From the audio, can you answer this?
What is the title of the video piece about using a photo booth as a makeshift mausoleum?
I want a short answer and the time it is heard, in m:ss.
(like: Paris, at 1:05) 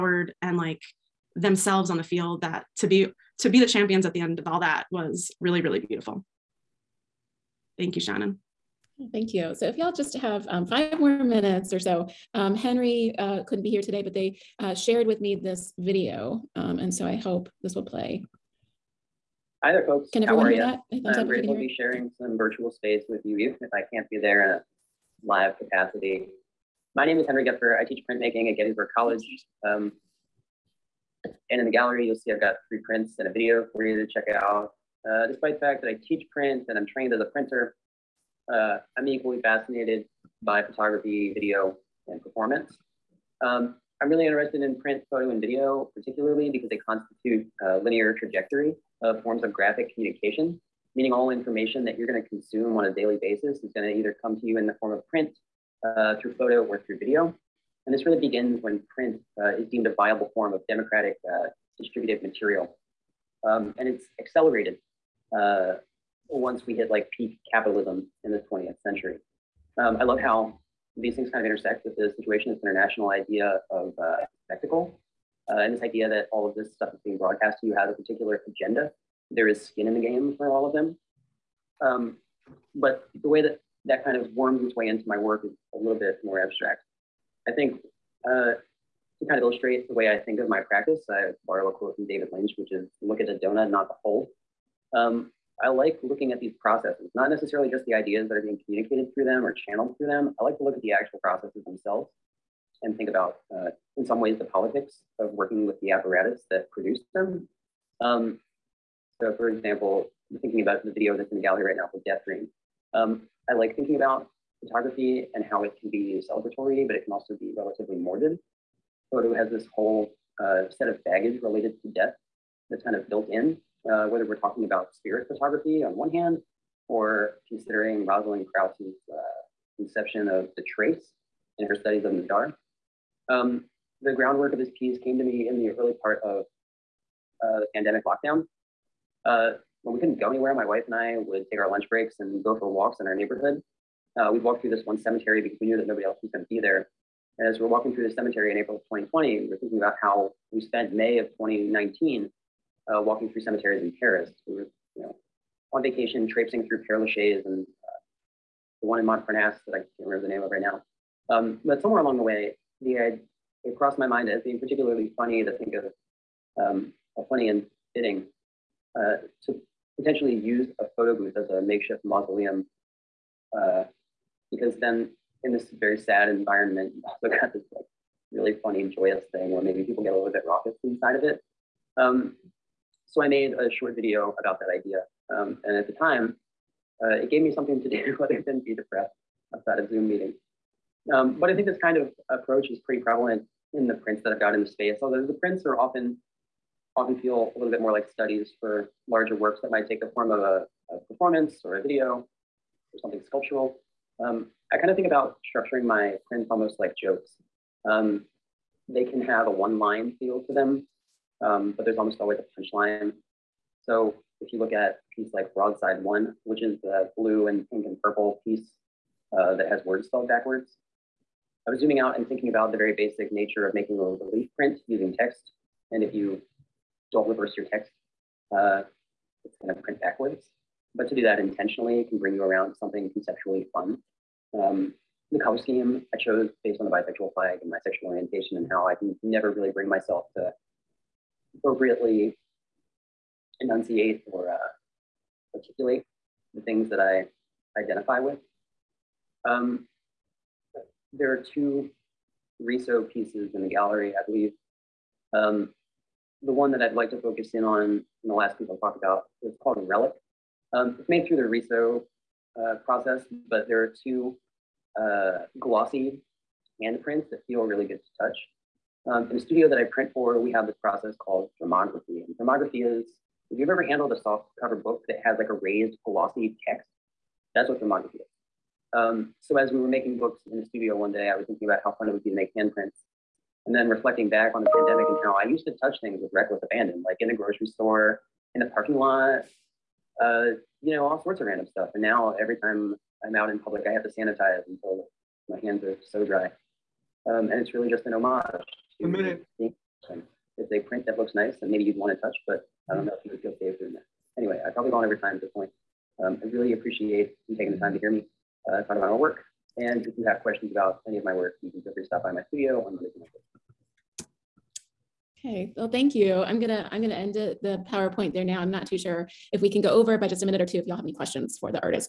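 Death Dream, at 1:52.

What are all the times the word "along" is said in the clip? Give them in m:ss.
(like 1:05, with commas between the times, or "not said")
2:41.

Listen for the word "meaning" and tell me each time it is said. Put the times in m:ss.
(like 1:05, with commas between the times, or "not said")
0:50.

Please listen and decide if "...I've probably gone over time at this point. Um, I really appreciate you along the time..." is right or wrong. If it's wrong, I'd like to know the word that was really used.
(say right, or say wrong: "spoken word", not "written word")
wrong: "taking", not "along".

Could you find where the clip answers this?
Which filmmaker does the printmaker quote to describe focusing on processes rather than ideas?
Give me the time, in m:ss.
1:32.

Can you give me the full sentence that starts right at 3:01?
Um, so I made a short video about that idea.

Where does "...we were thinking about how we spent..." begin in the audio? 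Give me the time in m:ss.
2:29.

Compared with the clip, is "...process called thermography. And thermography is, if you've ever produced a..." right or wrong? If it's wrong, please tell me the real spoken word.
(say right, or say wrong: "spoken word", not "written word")
wrong: "handled", not "produced".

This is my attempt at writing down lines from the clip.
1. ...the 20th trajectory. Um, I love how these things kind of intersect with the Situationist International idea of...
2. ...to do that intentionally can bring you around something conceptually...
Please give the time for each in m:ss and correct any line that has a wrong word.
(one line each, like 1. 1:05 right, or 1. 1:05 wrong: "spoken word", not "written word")
1. 1:08 wrong: "century", not "trajectory"
2. 3:51 right.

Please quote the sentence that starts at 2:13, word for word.
Um, the groundwork of this piece came to me in the early part of uh, the pandemic lockdown.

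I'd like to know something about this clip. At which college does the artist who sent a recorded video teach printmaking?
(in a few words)
Gettysburg College.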